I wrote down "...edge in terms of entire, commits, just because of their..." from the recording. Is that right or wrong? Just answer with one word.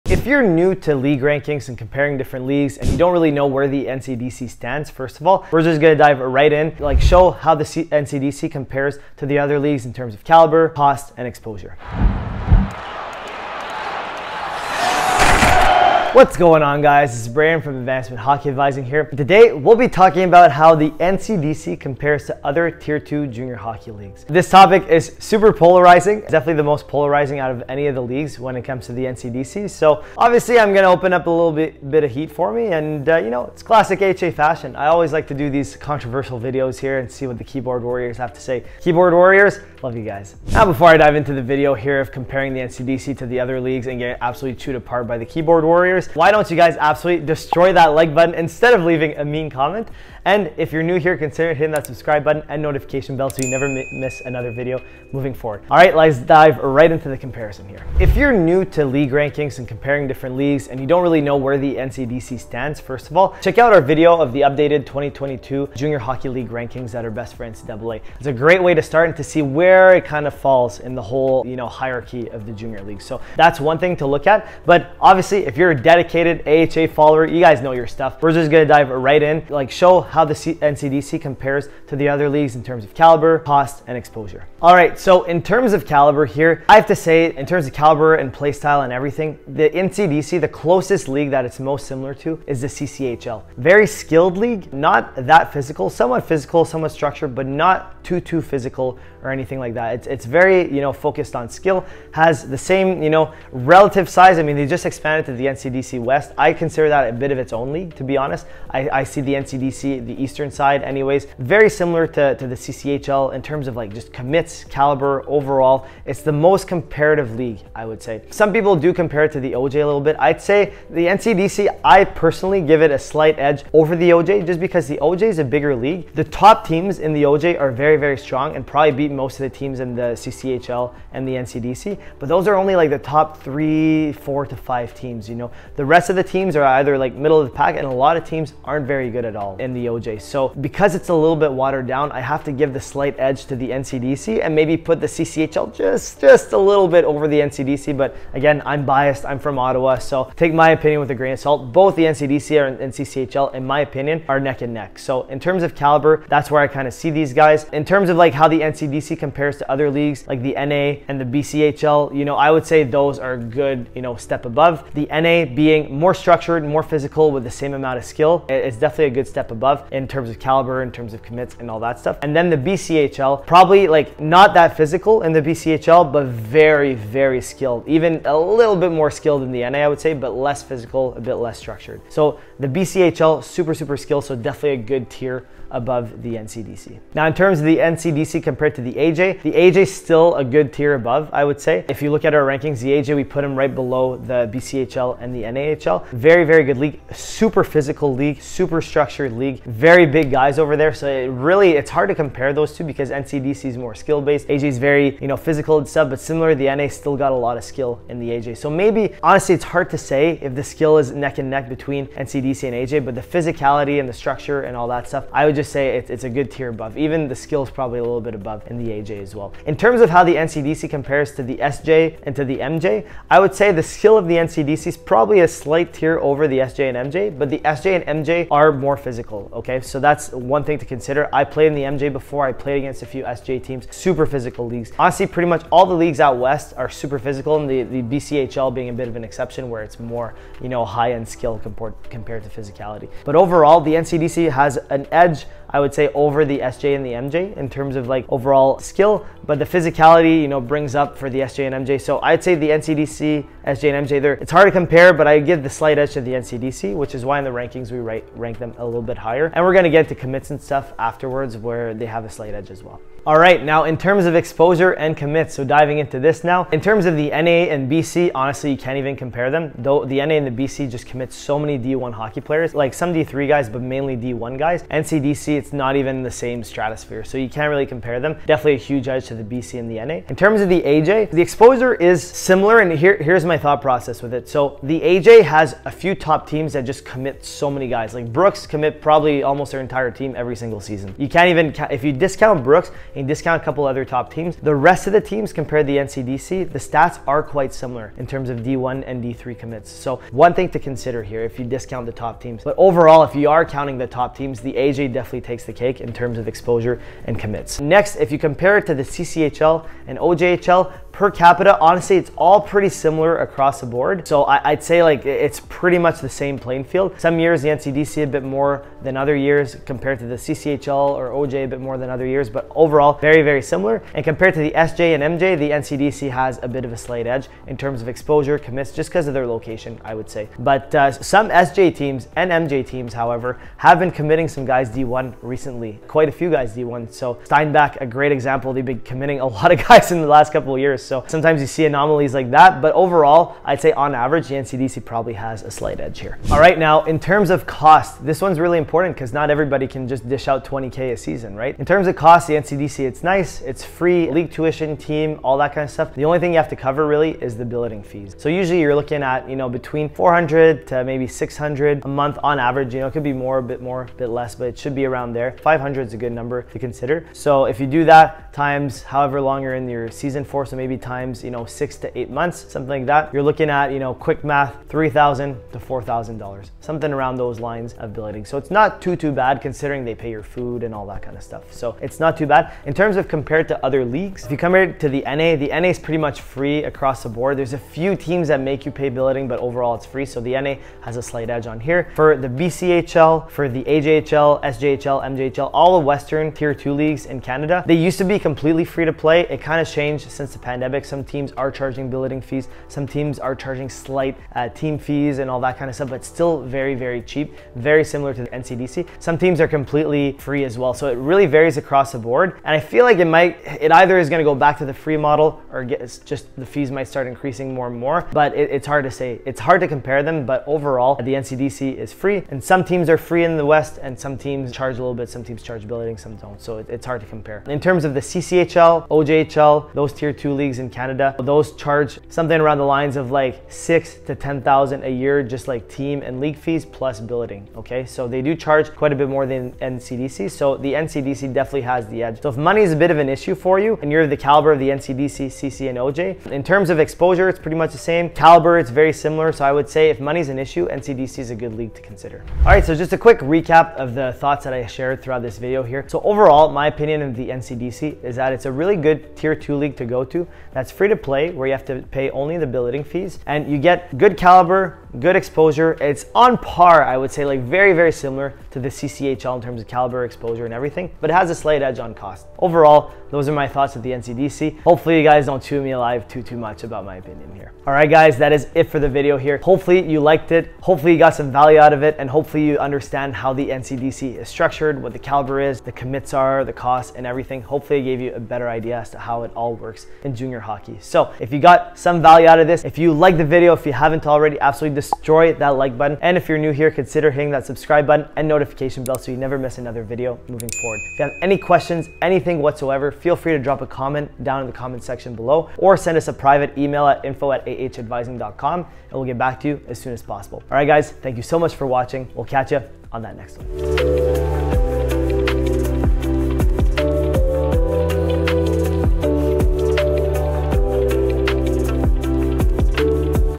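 wrong.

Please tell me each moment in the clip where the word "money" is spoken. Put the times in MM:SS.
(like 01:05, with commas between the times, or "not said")
07:22, 07:30.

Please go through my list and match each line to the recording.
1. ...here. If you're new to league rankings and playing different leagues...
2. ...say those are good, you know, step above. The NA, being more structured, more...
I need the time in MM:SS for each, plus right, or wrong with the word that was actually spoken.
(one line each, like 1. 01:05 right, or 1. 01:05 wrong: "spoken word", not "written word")
1. 00:57 wrong: "comparing", not "playing"
2. 02:42 right.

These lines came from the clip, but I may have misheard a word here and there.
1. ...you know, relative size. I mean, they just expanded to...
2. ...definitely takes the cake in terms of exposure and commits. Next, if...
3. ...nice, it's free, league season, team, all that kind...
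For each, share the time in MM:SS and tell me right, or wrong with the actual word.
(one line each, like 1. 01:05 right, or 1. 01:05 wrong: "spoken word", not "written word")
1. 01:43 right
2. 05:05 right
3. 05:53 wrong: "tuition", not "season".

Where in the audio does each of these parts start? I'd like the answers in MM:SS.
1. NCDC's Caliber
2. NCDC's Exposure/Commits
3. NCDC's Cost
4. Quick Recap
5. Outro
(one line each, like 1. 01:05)
1. 01:24
2. 04:23
3. 05:46
4. 07:23
5. 08:27.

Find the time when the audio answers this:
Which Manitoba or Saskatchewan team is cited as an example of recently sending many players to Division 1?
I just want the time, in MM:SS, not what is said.
05:37.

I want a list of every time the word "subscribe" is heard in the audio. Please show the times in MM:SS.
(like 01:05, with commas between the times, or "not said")
00:51, 08:17.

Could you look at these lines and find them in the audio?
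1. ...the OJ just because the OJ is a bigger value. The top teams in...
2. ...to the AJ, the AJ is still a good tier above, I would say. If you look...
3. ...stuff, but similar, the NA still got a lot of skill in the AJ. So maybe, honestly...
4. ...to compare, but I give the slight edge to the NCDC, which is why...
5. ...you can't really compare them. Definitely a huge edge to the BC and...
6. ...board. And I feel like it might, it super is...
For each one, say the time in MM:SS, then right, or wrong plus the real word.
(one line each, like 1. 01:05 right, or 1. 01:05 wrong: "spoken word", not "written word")
1. 02:03 wrong: "league", not "value"
2. 03:08 right
3. 03:25 right
4. 04:14 right
5. 04:37 right
6. 06:52 wrong: "either", not "super".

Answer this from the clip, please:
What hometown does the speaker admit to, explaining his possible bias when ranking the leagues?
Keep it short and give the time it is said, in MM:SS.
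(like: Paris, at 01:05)
Ottawa, at 02:29.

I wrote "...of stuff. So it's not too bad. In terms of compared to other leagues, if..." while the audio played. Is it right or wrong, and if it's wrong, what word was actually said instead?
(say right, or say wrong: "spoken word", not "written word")
right.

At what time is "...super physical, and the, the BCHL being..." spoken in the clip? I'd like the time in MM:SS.
03:56.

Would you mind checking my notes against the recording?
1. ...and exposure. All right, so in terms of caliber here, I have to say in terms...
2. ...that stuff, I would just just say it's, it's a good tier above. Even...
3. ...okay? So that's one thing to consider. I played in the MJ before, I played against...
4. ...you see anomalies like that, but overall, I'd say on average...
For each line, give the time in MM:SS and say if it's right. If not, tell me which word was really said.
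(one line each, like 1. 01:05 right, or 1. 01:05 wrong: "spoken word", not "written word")
1. 01:23 right
2. 03:34 right
3. 03:49 right
4. 05:41 right.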